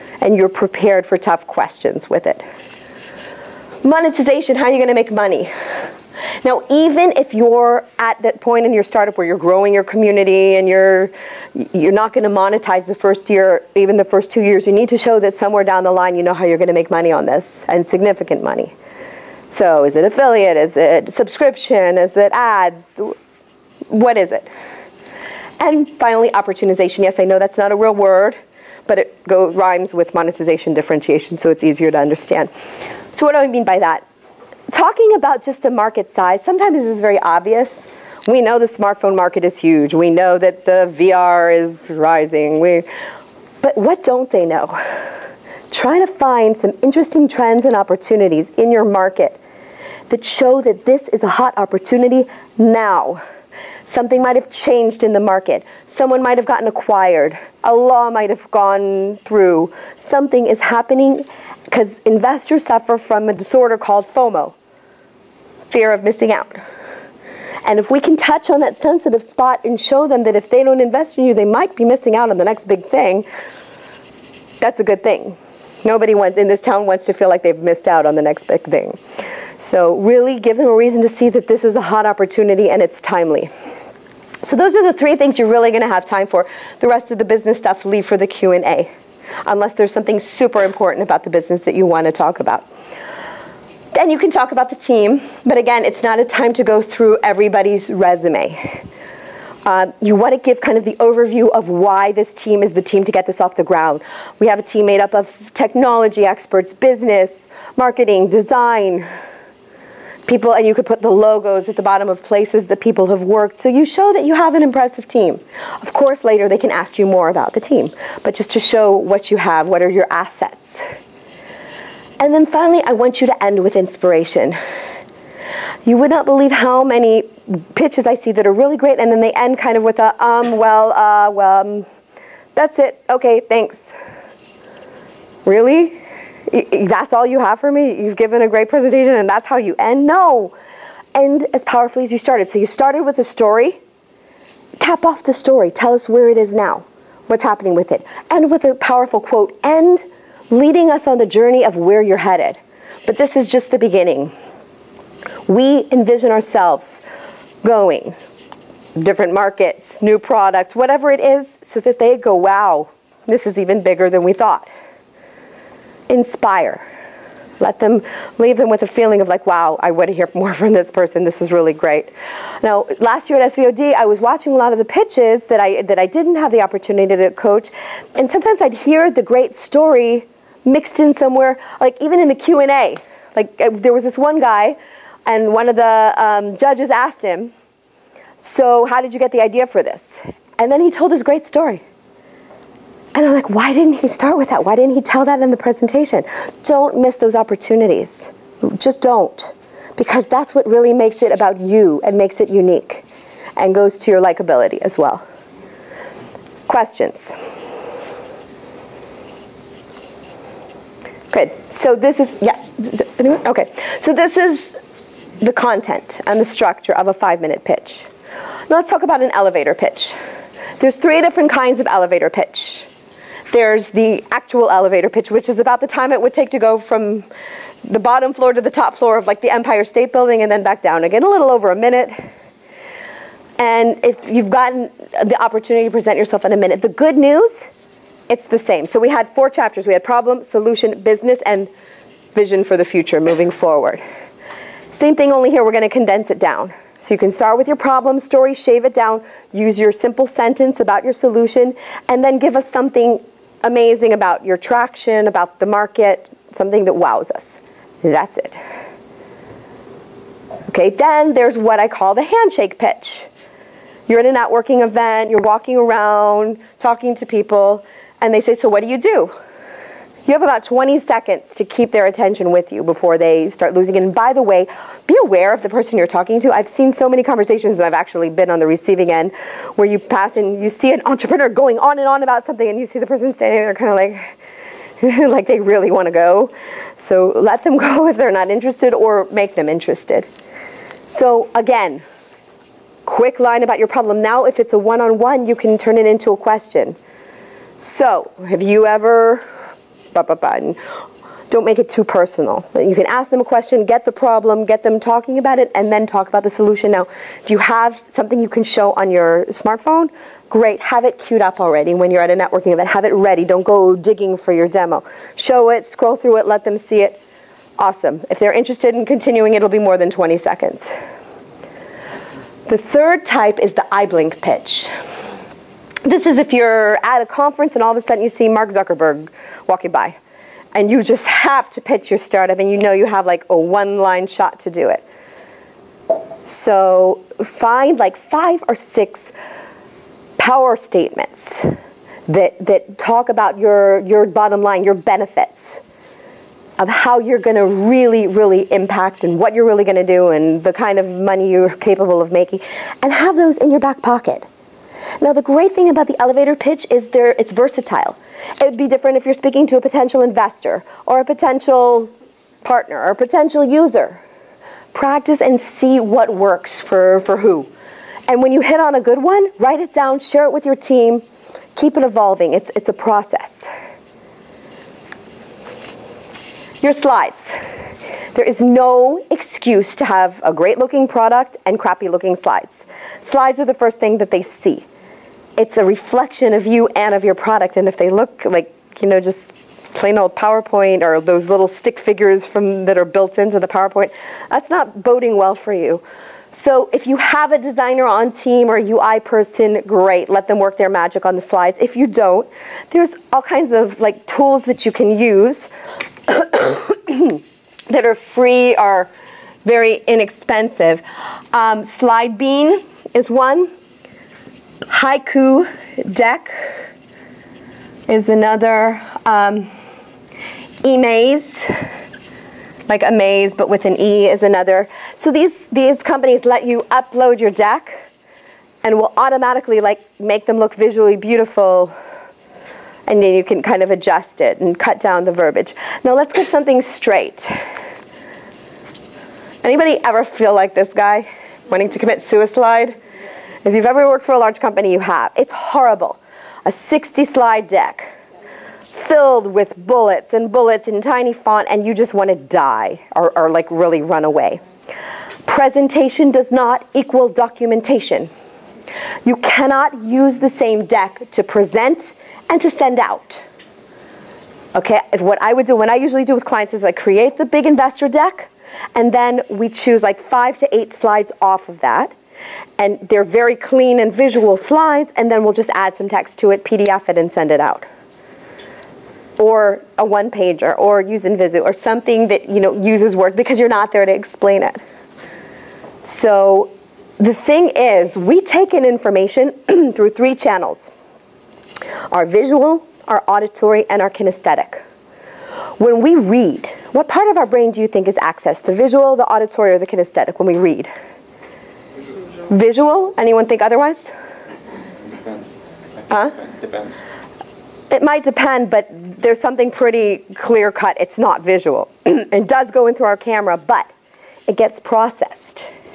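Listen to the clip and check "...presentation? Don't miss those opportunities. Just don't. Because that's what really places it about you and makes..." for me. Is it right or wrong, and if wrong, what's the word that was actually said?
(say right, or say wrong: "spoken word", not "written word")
wrong: "makes", not "places".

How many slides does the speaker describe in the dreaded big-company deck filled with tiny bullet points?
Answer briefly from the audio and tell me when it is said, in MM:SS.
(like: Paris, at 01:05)
60, at 07:26.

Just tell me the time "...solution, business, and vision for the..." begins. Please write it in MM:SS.
04:00.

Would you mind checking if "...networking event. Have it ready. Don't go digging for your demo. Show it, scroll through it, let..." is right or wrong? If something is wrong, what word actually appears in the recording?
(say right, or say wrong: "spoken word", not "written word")
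right.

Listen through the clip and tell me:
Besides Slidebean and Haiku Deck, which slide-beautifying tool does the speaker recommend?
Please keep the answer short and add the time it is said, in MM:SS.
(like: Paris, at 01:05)
emaze, at 07:00.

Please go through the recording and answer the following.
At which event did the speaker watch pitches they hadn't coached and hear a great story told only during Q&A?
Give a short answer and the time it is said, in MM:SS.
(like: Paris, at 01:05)
SVOD, at 02:53.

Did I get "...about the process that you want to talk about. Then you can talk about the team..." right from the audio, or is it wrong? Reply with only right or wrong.
wrong.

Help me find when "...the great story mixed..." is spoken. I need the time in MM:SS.
02:59.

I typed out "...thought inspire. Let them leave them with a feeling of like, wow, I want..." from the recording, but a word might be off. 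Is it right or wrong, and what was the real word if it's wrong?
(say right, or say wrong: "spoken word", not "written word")
right.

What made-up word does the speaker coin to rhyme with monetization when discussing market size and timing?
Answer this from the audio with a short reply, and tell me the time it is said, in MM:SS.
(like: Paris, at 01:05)
opportunization, at 00:26.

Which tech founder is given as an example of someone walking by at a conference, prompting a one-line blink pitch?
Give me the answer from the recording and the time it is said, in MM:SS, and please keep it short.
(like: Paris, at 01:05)
Mark Zuckerberg, at 05:28.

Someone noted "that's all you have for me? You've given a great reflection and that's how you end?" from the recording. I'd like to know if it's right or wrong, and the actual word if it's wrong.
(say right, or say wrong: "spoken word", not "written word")
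wrong: "presentation", not "reflection".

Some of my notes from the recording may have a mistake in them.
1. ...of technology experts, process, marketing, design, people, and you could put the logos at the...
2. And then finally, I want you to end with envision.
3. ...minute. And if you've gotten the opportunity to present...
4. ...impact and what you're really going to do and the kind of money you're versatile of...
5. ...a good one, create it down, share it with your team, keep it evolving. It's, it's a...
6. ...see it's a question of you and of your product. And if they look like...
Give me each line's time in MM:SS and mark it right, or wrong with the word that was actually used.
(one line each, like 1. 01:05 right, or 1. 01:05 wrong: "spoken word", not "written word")
1. 01:45 wrong: "business", not "process"
2. 02:02 wrong: "inspiration", not "envision"
3. 03:51 right
4. 05:48 wrong: "capable", not "versatile"
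5. 06:08 wrong: "write", not "create"
6. 06:24 wrong: "reflection", not "question".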